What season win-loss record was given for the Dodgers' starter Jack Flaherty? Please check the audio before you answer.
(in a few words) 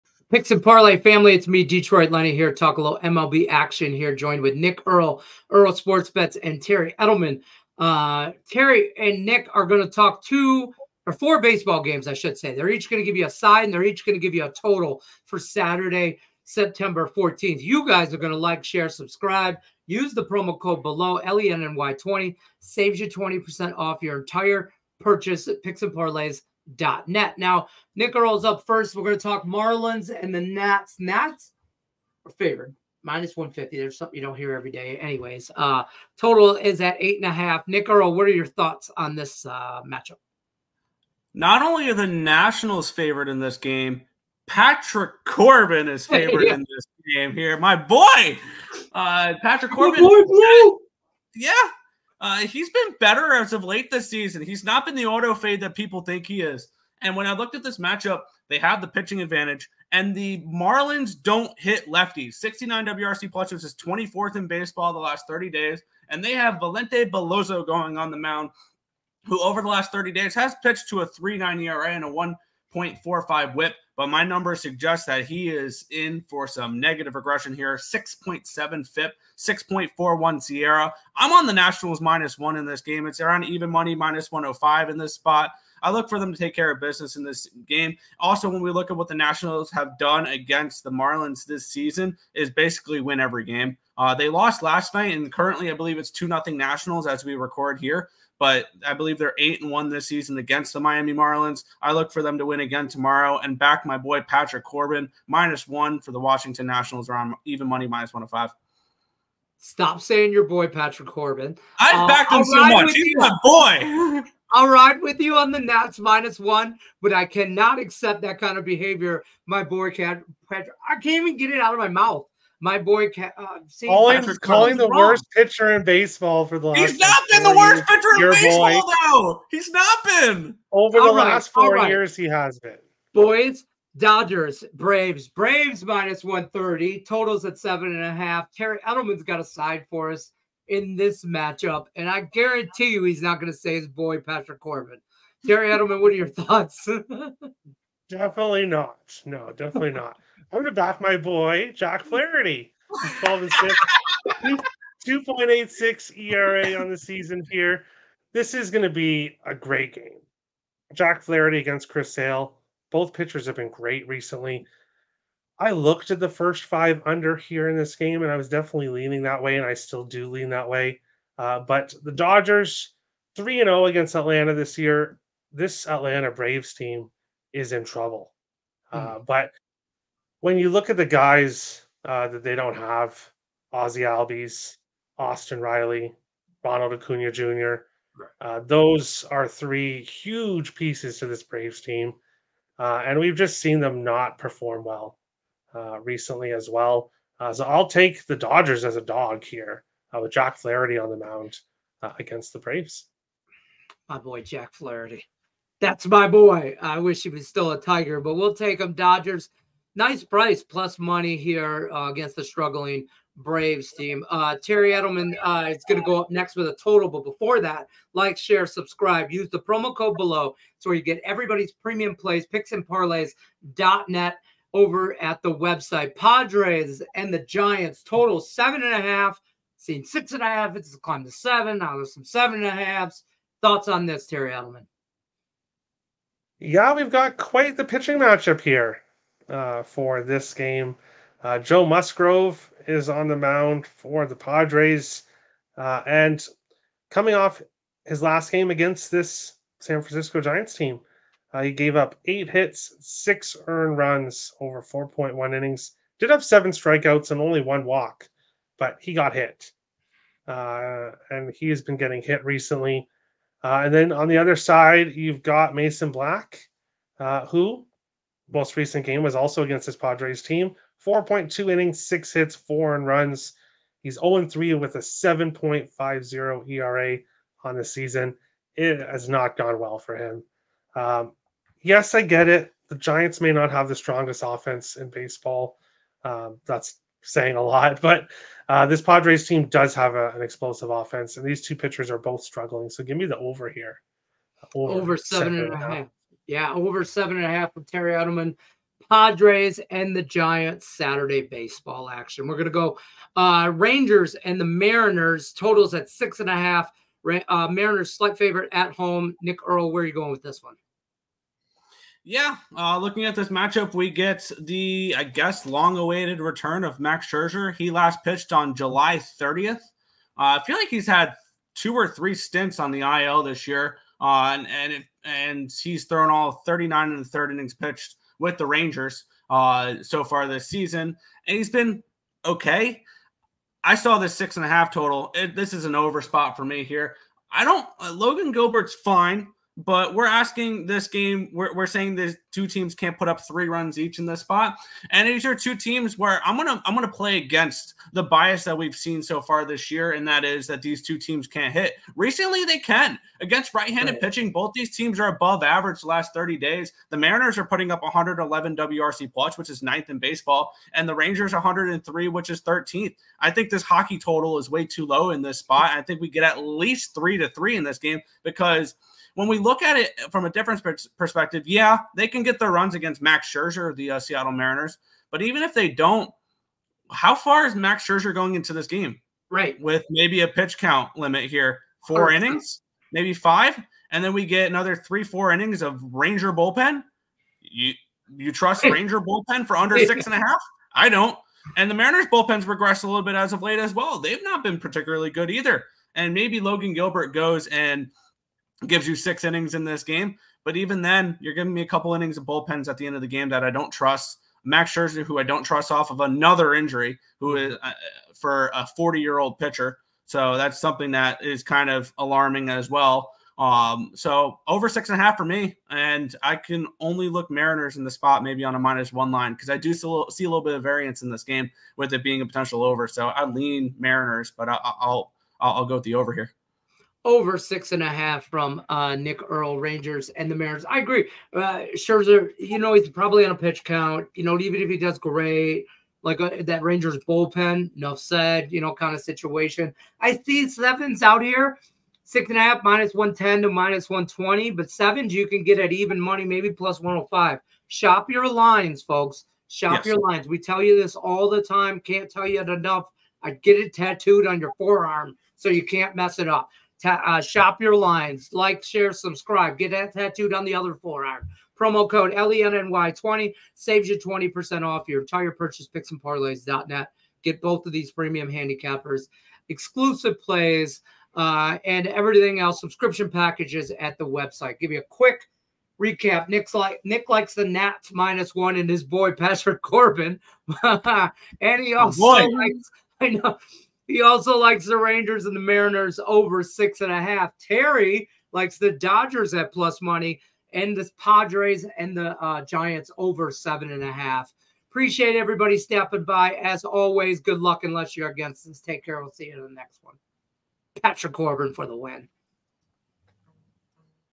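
12 and 6.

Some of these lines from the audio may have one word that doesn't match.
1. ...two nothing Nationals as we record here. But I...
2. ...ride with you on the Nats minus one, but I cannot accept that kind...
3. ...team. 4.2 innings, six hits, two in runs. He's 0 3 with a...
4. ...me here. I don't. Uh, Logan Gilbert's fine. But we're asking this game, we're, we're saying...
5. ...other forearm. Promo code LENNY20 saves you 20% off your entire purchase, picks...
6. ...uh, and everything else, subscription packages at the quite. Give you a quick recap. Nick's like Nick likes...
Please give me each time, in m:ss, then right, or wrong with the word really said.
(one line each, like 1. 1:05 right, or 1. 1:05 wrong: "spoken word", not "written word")
1. 1:36 right
2. 1:54 right
3. 4:30 wrong: "four", not "two"
4. 5:36 right
5. 7:40 right
6. 7:51 wrong: "website", not "quite".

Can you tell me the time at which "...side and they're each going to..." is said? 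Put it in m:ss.
0:13.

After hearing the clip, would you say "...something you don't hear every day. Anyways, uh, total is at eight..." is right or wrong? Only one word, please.
right.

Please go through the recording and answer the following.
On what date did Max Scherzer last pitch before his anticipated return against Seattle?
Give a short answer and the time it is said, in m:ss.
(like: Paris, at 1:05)
July 30th, at 5:18.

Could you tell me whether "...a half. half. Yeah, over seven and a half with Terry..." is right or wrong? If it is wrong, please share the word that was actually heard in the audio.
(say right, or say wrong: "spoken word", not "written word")
right.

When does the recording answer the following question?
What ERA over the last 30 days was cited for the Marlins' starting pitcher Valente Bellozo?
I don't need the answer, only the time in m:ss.
1:11.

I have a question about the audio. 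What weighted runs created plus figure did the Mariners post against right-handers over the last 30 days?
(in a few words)
111.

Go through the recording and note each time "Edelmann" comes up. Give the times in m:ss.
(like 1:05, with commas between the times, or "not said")
0:07, 2:18, 2:25, 3:34, 3:54, 4:58.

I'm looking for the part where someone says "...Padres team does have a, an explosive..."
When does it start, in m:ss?
4:49.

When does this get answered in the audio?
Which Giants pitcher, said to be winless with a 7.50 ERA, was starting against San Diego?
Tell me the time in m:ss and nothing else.
4:25.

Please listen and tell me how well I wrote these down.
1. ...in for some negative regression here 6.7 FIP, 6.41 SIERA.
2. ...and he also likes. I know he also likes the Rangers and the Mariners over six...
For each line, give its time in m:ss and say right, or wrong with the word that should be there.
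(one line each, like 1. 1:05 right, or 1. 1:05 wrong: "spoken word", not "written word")
1. 1:15 right
2. 8:00 right.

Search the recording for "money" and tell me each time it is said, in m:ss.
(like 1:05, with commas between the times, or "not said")
1:23, 1:47, 3:30, 7:26, 8:10.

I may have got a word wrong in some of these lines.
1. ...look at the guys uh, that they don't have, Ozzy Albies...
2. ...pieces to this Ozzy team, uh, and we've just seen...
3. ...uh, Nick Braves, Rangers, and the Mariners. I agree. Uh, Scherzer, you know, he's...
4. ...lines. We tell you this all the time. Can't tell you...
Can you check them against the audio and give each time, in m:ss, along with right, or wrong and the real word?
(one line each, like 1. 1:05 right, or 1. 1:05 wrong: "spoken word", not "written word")
1. 3:00 right
2. 3:10 wrong: "Braves", not "Ozzy"
3. 7:08 wrong: "Earle", not "Braves"
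4. 7:30 right.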